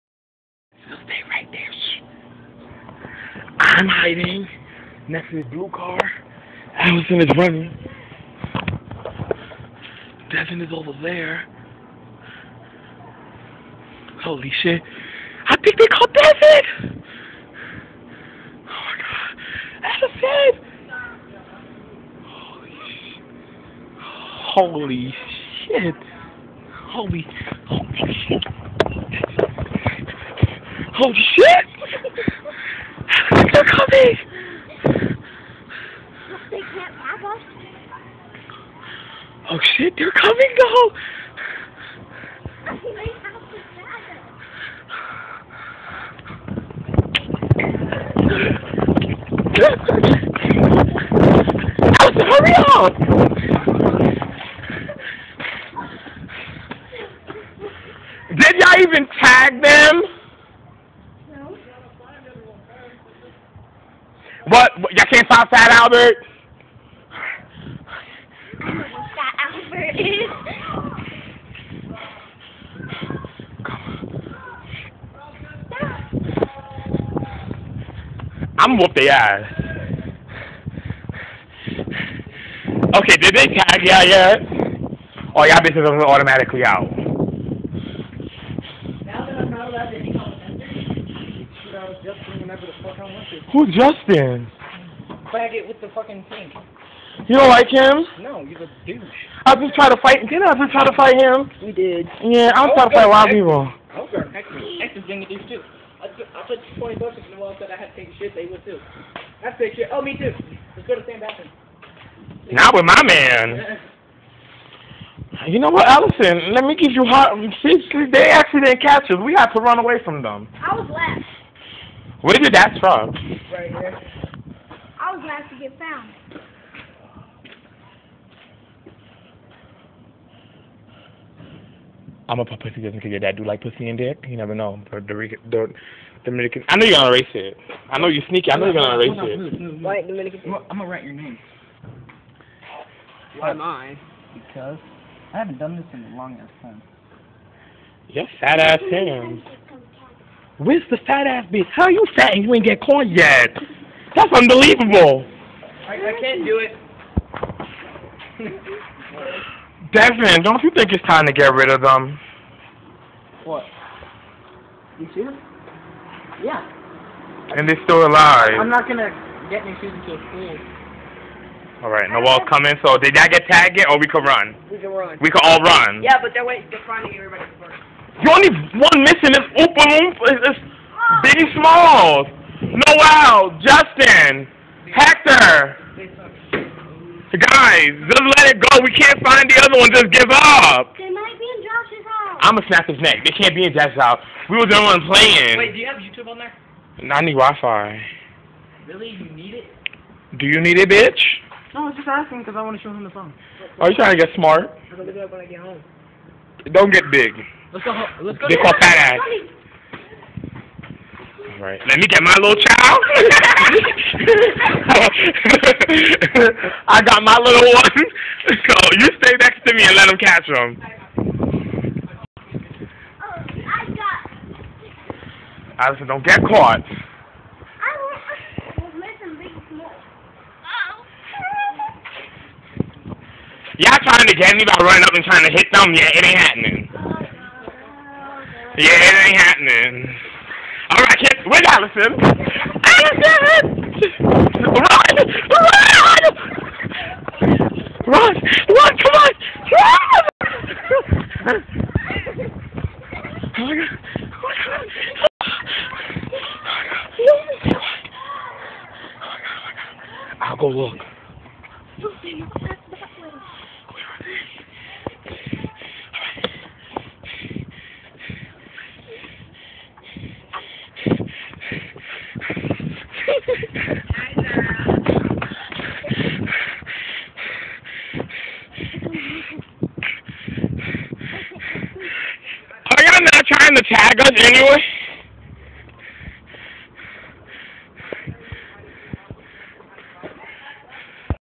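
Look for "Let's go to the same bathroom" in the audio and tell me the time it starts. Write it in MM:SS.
01:50.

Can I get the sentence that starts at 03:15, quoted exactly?
Wait, do you have YouTube on there?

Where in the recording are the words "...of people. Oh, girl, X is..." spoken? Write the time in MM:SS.
01:43.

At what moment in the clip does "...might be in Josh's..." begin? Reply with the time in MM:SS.
03:11.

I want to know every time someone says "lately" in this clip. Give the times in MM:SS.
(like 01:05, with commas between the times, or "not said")
not said.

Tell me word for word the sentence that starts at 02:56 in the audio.
Yeah, but they're waiting, they're everybody first.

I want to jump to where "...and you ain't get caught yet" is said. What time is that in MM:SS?
02:32.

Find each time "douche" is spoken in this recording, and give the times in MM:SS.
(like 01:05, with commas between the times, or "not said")
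01:38.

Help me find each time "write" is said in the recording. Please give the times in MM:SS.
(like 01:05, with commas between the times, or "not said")
02:20.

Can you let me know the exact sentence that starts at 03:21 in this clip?
No, I was just asking because I want to show him the phone.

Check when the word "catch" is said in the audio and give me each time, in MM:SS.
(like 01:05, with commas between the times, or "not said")
01:58, 03:40.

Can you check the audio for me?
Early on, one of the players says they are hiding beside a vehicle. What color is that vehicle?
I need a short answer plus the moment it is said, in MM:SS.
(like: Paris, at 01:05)
Blue, at 00:05.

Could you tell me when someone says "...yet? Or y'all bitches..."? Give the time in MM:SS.
01:24.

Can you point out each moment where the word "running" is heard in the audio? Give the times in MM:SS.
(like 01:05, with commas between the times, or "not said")
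00:07, 03:54.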